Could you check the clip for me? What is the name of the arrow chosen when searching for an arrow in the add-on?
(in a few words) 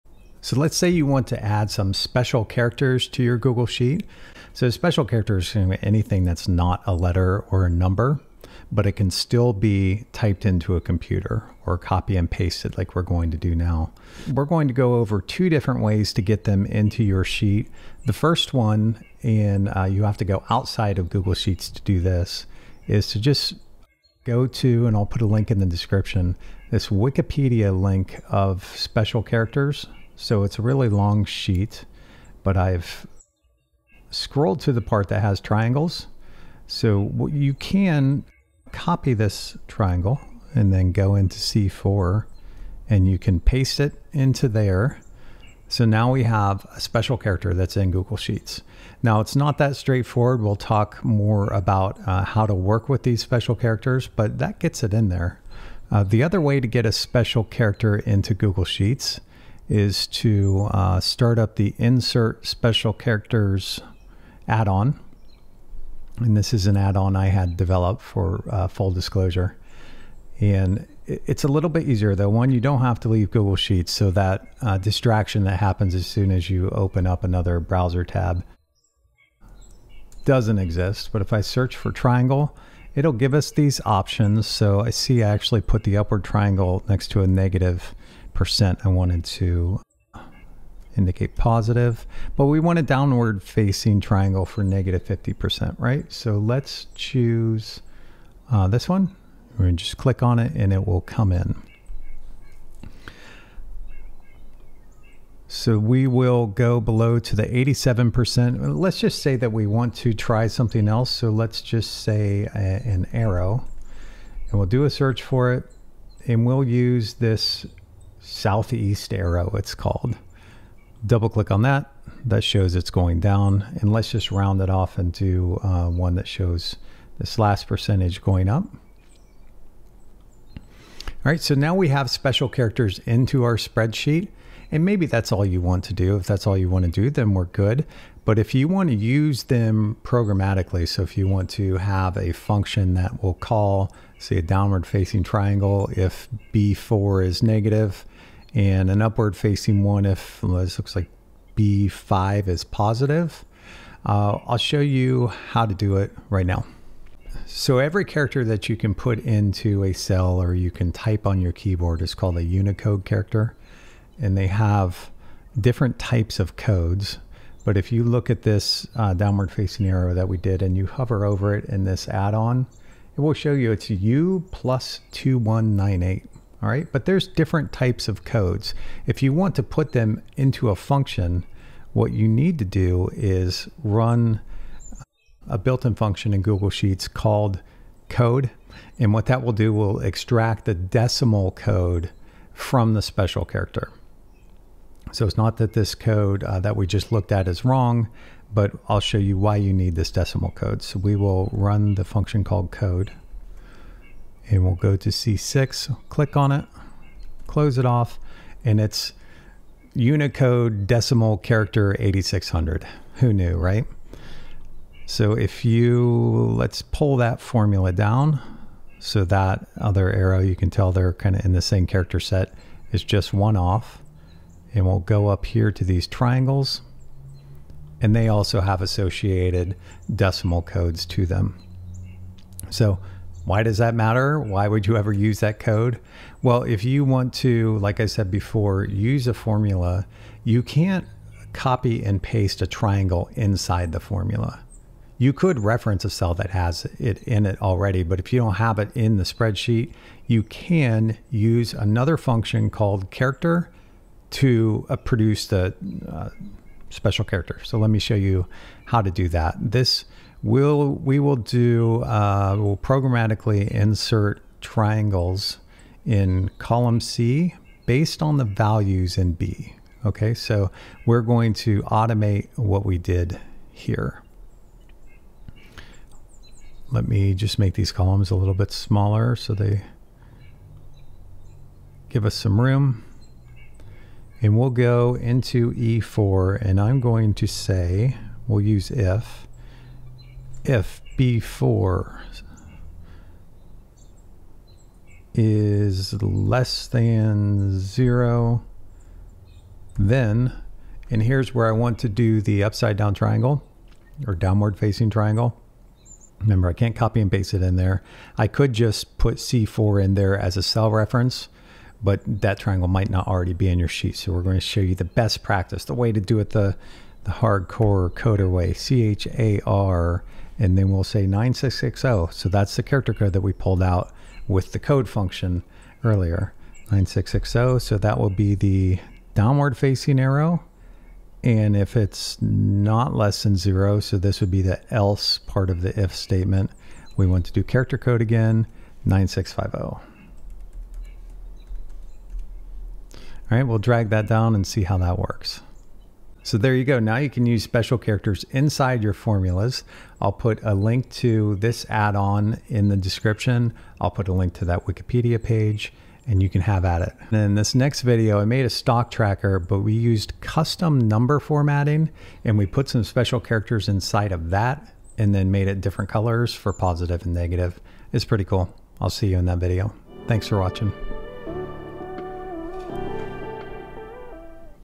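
southeast arrow.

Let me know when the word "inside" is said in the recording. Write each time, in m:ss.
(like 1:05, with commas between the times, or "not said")
4:03, 5:48, 6:03.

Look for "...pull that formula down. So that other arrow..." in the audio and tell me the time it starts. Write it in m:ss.
3:36.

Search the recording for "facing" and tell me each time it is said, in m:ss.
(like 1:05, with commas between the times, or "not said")
1:33, 2:24, 2:29, 2:49, 5:04, 5:29.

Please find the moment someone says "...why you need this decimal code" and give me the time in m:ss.
3:19.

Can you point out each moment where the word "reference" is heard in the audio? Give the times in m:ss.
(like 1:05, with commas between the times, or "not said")
4:05, 5:10.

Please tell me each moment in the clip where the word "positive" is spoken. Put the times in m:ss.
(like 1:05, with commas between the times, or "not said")
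1:31, 2:32, 6:06.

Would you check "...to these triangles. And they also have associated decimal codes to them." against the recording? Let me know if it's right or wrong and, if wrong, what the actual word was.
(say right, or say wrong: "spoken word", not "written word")
right.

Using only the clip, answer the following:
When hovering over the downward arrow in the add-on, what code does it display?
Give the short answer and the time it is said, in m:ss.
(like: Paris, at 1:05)
U+2198, at 2:53.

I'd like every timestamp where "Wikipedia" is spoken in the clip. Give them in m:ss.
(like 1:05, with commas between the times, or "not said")
0:26, 5:54.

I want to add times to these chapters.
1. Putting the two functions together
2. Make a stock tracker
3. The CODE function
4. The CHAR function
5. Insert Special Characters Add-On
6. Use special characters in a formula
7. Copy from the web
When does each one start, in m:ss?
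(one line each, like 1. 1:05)
1. 4:20
2. 5:57
3. 2:56
4. 3:55
5. 0:55
6. 2:09
7. 0:17.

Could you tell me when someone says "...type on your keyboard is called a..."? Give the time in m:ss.
2:40.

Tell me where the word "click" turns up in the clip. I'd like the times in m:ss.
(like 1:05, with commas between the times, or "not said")
1:39, 2:01, 3:26.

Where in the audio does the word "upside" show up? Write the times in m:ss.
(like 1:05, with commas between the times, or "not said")
5:02.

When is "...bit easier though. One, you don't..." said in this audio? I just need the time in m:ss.
1:11.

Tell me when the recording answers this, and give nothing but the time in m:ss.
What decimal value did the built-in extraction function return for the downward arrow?
3:31.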